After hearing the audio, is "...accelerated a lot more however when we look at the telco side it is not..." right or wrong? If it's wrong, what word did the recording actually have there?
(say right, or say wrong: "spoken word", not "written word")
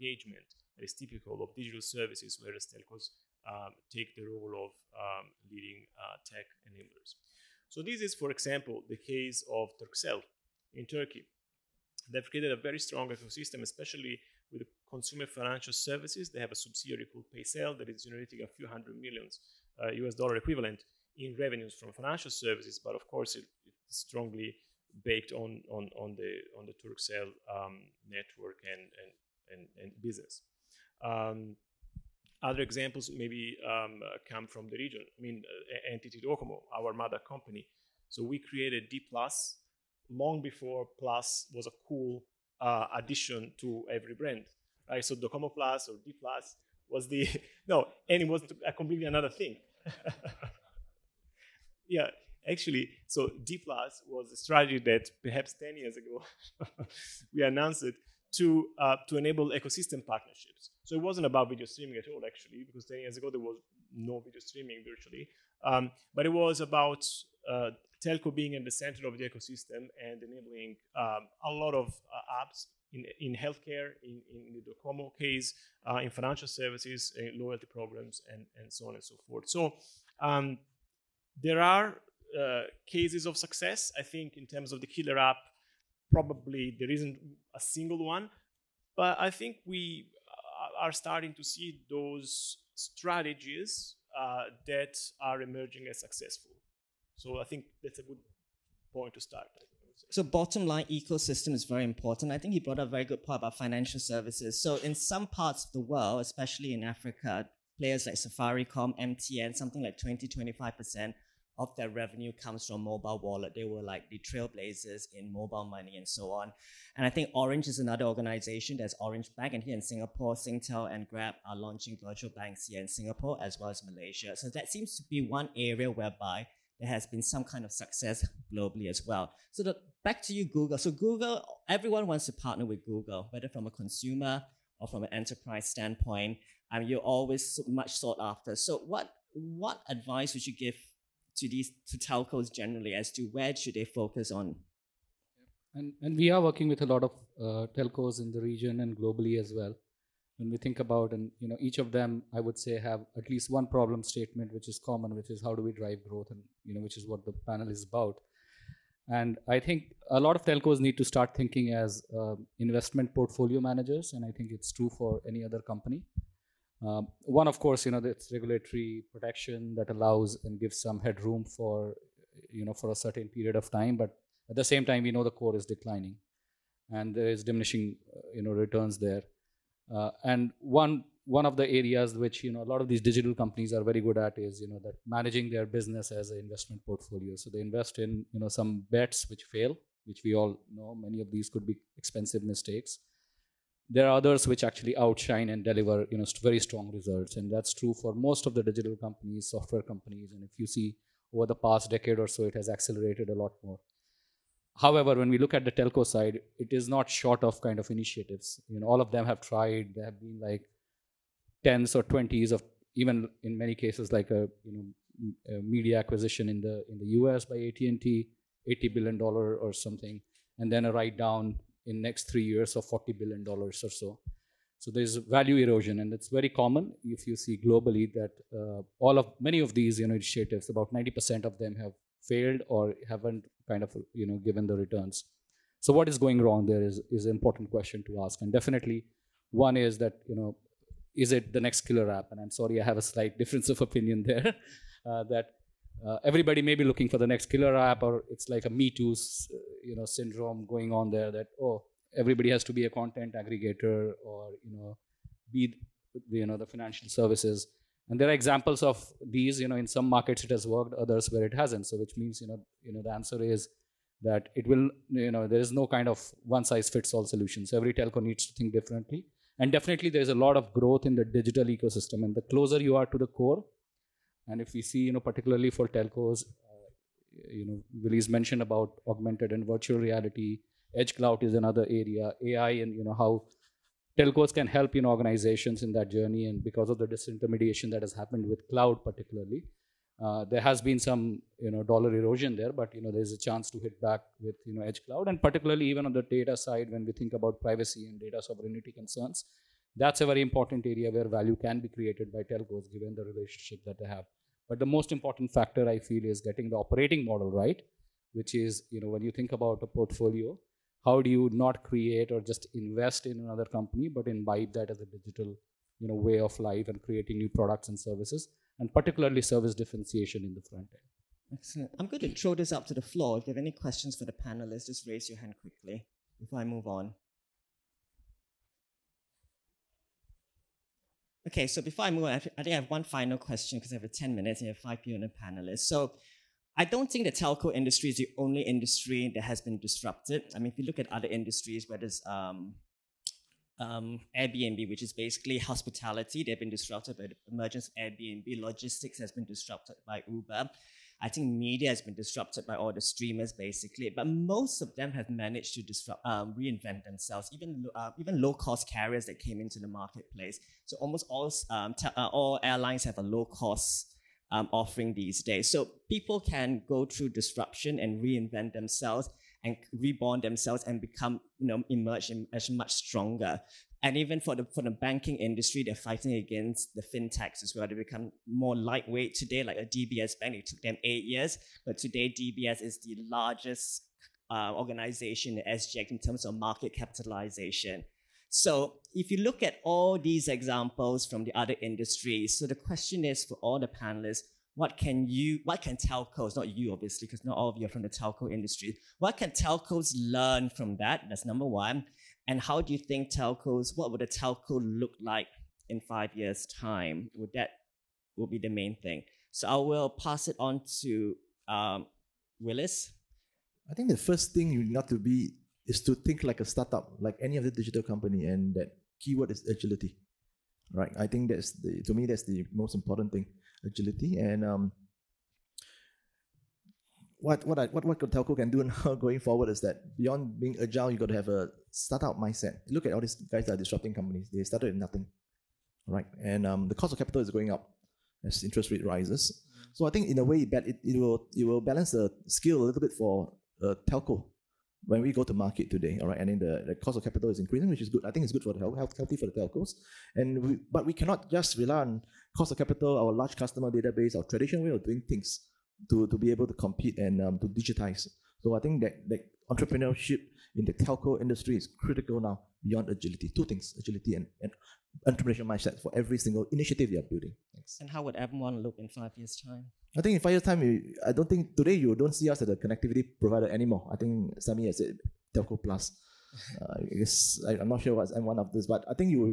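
right.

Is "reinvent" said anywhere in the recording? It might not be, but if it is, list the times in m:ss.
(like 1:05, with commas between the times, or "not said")
5:56, 6:08.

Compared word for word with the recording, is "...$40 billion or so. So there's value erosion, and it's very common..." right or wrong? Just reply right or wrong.
right.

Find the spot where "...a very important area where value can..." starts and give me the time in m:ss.
5:00.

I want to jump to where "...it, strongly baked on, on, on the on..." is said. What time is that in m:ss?
0:23.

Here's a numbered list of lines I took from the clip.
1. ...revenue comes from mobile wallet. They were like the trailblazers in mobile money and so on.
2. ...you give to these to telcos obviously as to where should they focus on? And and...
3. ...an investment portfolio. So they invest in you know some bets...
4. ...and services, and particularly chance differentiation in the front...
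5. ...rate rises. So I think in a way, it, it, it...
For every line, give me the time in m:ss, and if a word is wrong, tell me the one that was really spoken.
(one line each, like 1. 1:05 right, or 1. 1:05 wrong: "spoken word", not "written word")
1. 1:51 right
2. 2:20 wrong: "generally", not "obviously"
3. 3:06 right
4. 5:17 wrong: "service", not "chance"
5. 7:18 right.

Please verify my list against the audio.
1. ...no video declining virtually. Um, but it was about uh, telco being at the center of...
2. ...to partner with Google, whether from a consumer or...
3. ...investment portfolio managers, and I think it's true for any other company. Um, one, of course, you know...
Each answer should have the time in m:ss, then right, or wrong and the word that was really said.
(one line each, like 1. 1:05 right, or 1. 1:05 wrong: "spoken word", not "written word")
1. 1:03 wrong: "streaming", not "declining"
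2. 2:12 right
3. 2:42 right.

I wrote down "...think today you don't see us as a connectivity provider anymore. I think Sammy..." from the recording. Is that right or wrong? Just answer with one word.
right.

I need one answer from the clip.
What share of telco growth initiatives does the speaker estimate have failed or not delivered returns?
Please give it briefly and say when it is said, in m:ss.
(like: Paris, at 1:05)
90%, at 3:50.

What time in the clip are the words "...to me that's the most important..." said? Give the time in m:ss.
7:02.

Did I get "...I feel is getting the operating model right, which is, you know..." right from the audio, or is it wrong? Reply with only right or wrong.
right.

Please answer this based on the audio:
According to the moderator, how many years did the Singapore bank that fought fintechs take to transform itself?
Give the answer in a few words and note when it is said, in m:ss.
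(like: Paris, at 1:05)
8 years, at 6:21.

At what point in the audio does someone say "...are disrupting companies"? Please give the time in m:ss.
7:13.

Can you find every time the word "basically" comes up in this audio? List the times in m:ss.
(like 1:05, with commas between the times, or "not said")
5:45, 5:53.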